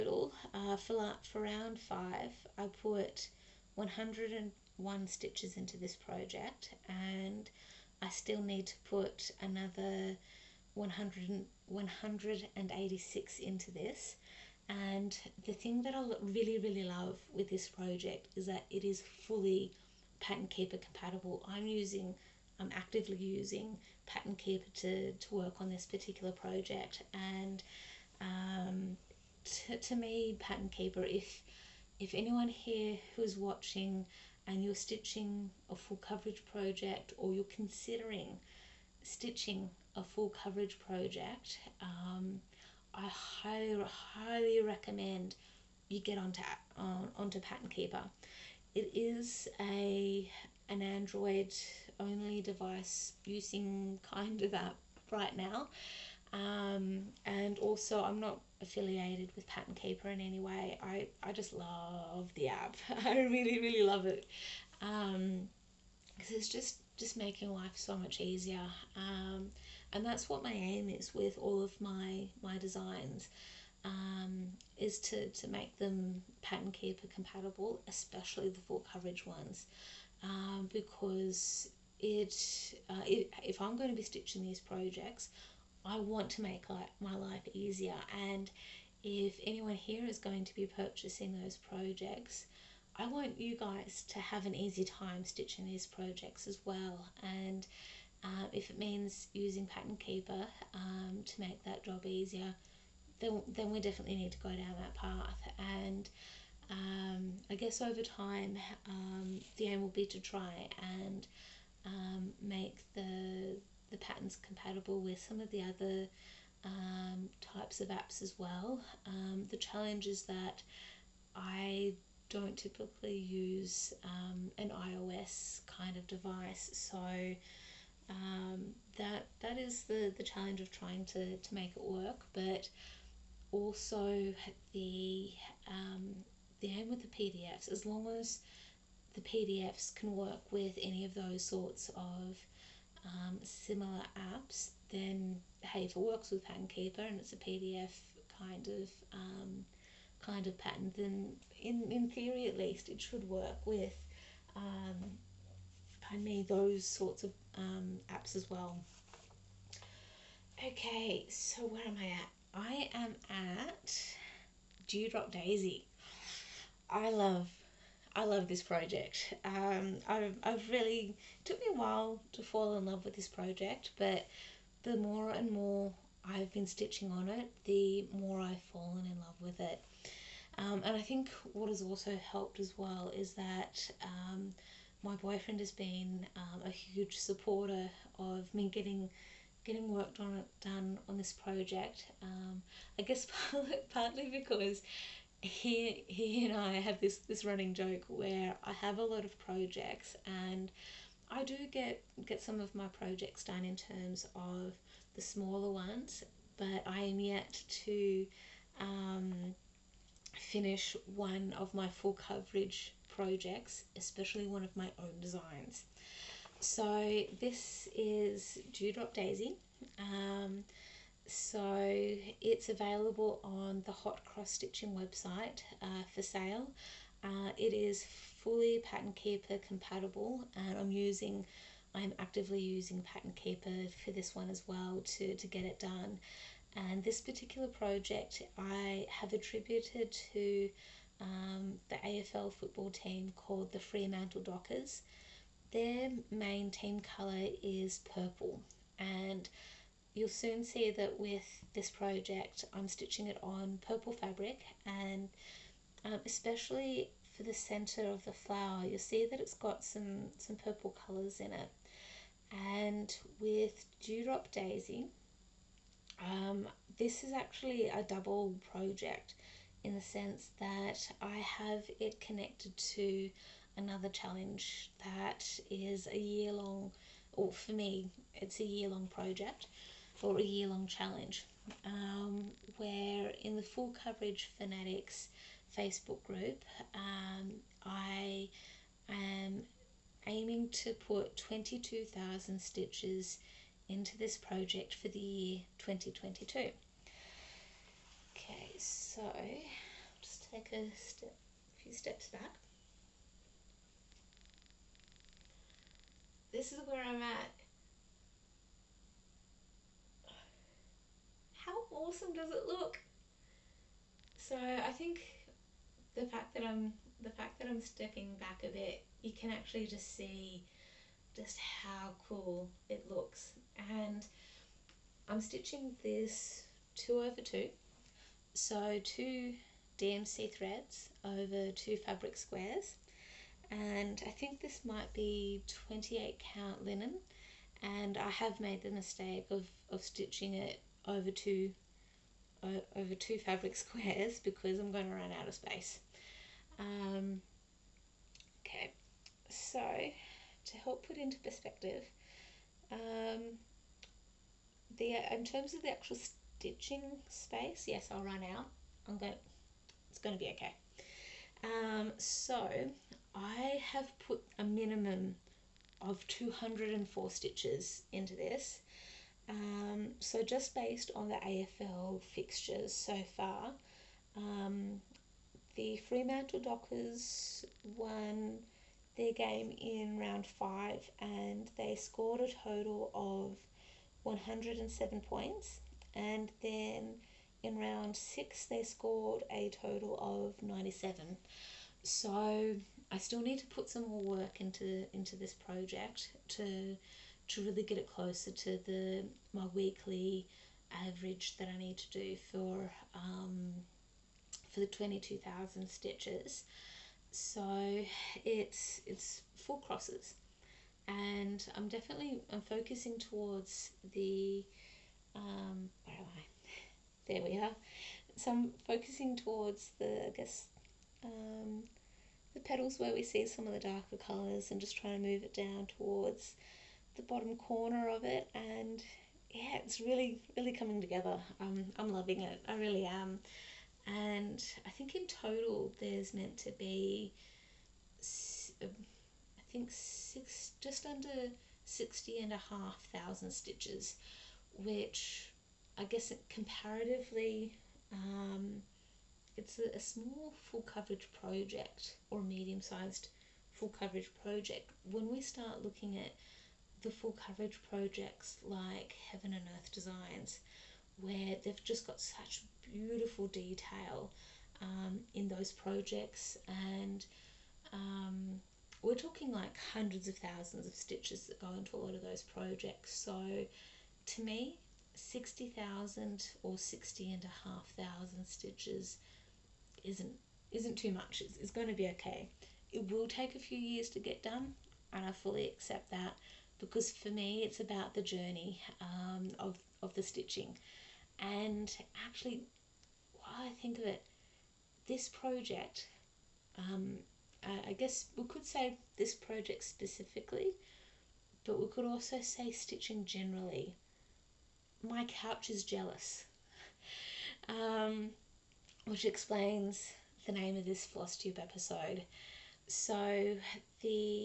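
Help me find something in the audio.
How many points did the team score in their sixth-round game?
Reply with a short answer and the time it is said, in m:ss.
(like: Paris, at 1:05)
97, at 6:30.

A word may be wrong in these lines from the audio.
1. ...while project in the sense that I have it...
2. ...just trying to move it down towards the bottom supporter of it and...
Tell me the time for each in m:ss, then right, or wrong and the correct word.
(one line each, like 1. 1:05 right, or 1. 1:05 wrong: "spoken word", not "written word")
1. 4:28 wrong: "double", not "while"
2. 7:04 wrong: "corner", not "supporter".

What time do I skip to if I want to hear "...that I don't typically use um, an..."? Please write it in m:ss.
2:00.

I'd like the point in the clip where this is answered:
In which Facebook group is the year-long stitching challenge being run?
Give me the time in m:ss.
4:43.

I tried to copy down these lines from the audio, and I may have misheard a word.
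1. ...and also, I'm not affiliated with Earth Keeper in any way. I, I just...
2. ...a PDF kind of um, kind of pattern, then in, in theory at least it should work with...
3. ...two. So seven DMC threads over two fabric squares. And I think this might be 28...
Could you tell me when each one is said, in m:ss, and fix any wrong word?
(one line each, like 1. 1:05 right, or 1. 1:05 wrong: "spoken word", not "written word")
1. 0:57 wrong: "Pattern", not "Earth"
2. 2:27 right
3. 5:27 wrong: "two", not "seven".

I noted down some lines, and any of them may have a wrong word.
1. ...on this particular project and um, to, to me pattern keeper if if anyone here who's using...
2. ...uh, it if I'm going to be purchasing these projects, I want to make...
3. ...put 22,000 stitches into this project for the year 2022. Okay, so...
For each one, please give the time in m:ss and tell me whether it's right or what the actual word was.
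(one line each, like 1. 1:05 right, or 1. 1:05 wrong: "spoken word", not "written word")
1. 0:25 wrong: "watching", not "using"
2. 1:22 wrong: "stitching", not "purchasing"
3. 4:50 right.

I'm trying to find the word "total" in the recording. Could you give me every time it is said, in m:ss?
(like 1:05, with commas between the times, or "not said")
6:22, 6:29, 7:15.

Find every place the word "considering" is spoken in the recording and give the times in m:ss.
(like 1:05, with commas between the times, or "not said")
0:37.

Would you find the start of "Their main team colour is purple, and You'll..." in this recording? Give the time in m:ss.
4:05.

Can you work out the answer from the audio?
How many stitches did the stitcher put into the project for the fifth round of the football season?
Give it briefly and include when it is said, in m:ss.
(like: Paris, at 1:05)
101, at 0:03.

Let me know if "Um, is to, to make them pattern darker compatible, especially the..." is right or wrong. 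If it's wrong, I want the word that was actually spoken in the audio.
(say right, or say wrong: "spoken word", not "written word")
wrong: "keeper", not "darker".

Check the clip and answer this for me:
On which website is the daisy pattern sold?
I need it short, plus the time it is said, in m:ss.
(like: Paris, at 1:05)
Hot Cross Stitching, at 3:43.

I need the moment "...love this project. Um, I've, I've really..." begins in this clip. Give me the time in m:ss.
2:48.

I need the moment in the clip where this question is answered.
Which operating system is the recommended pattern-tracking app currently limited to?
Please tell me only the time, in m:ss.
0:50.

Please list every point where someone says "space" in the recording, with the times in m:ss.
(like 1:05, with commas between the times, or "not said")
5:45, 5:57.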